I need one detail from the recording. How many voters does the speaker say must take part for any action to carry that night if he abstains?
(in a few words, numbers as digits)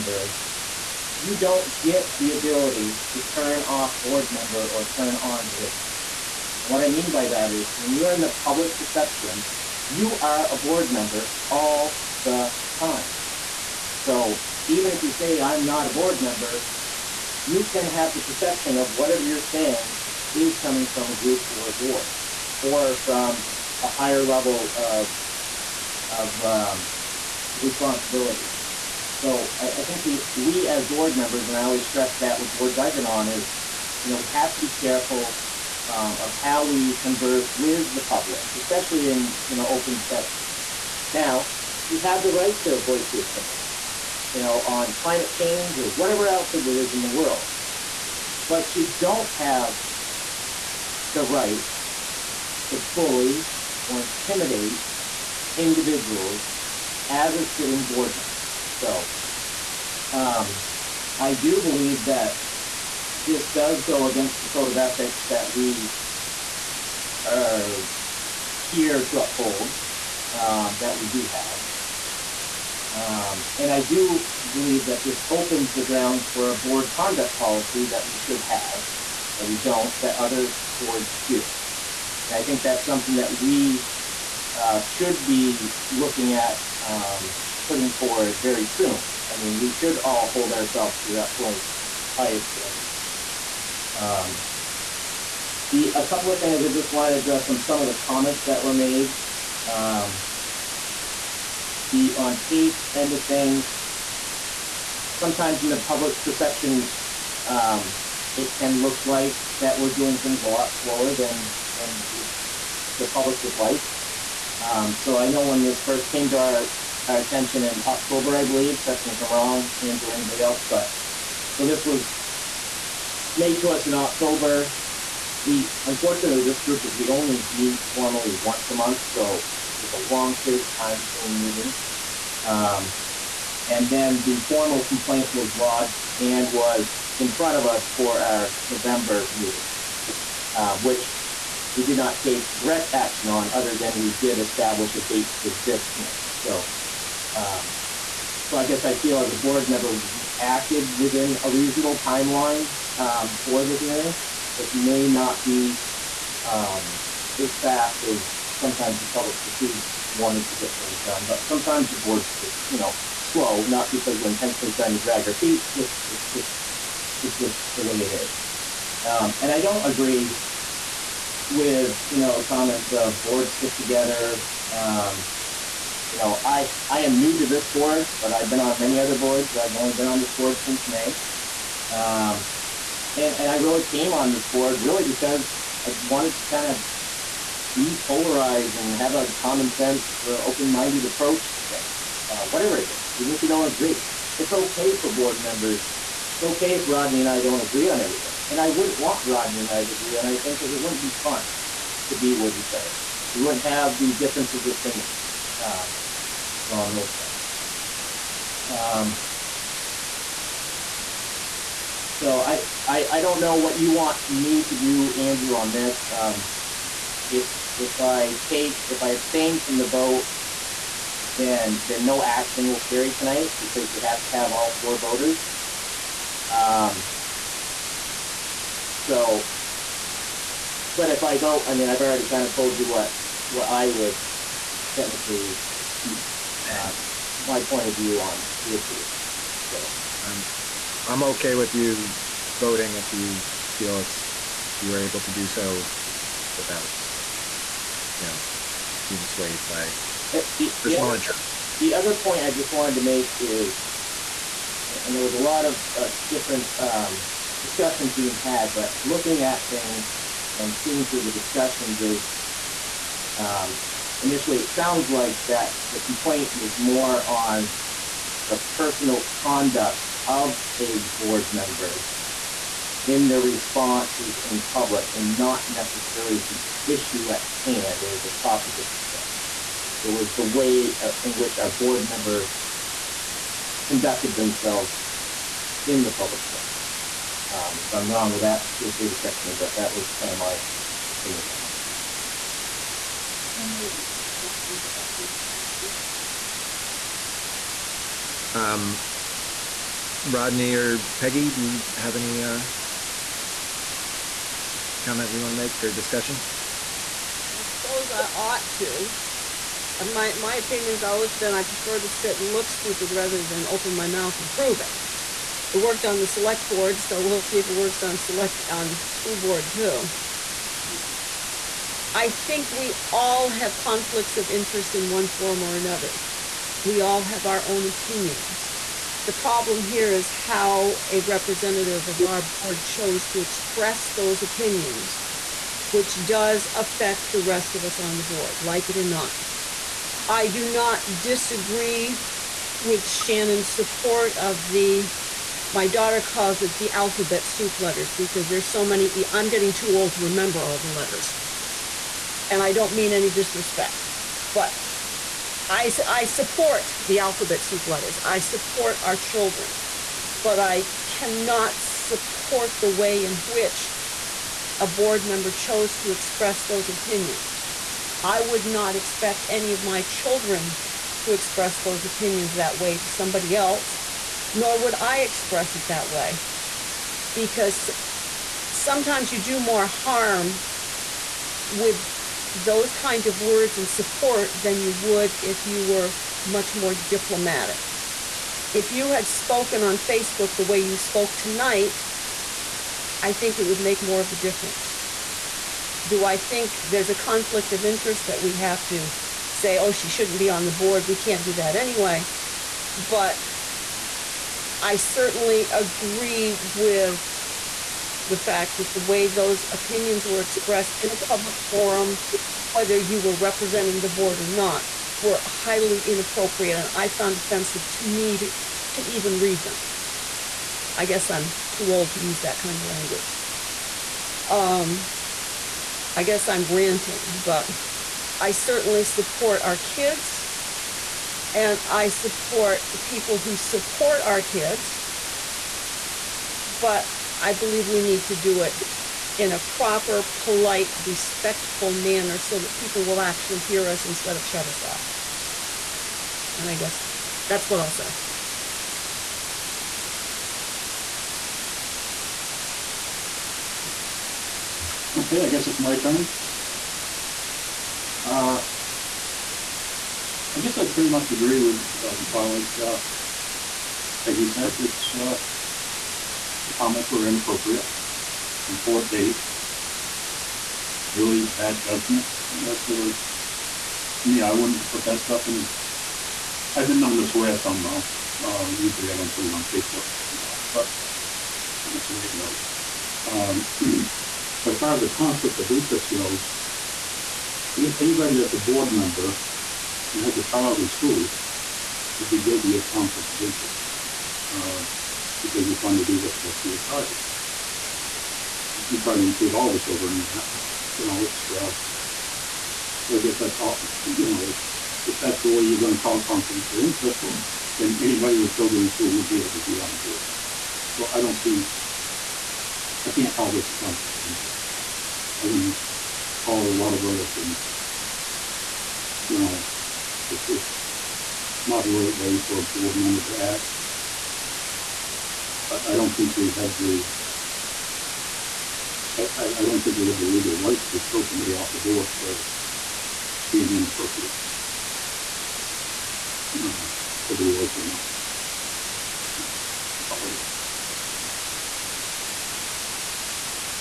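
4.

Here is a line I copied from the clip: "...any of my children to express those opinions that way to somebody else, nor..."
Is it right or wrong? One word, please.
right.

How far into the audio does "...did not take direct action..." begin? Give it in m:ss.
2:21.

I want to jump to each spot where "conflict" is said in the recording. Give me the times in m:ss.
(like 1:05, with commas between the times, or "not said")
5:23, 6:37, 8:05, 8:12, 8:26, 8:33.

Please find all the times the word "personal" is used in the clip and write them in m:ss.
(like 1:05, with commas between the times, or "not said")
4:10, 4:28.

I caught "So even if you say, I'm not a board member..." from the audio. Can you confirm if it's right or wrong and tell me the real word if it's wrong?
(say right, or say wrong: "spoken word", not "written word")
right.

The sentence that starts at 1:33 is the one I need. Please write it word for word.
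Um, the a couple of things I just wanted to address on some of the comments that were made.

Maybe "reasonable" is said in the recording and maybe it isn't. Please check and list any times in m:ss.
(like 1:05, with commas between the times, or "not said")
2:31.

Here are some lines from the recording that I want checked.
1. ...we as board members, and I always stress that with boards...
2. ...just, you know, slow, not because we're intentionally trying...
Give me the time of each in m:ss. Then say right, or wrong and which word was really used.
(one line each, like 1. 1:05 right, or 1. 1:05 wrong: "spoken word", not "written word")
1. 0:30 right
2. 2:42 right.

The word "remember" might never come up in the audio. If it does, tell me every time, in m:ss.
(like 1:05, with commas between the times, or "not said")
5:50.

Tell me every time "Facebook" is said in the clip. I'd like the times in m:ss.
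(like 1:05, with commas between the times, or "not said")
6:29, 7:59.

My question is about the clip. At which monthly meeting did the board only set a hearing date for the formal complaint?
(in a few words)
November.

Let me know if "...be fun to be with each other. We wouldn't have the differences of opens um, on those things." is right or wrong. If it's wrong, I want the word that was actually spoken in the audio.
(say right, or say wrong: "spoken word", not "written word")
wrong: "opinions", not "opens".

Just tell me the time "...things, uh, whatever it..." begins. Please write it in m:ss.
3:11.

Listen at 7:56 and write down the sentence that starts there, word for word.
I've been known to swear some though.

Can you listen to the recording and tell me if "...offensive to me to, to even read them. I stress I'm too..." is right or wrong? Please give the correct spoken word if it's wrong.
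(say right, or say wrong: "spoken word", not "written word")
wrong: "guess", not "stress".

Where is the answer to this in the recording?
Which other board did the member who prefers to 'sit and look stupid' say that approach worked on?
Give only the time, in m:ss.
5:16.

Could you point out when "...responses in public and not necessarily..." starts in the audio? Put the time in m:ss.
4:33.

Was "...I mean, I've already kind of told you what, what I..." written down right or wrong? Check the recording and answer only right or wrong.
right.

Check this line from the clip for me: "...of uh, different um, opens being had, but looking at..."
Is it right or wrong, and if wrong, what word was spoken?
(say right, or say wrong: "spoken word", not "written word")
wrong: "discussions", not "opens".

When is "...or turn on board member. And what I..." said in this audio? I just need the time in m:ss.
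0:04.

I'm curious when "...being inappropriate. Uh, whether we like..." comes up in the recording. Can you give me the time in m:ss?
8:53.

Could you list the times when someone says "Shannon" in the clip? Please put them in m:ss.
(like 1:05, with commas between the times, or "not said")
5:43.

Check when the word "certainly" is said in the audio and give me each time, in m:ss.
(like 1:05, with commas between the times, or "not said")
6:44, 7:08.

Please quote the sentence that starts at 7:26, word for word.
And I guess that's what I'll say.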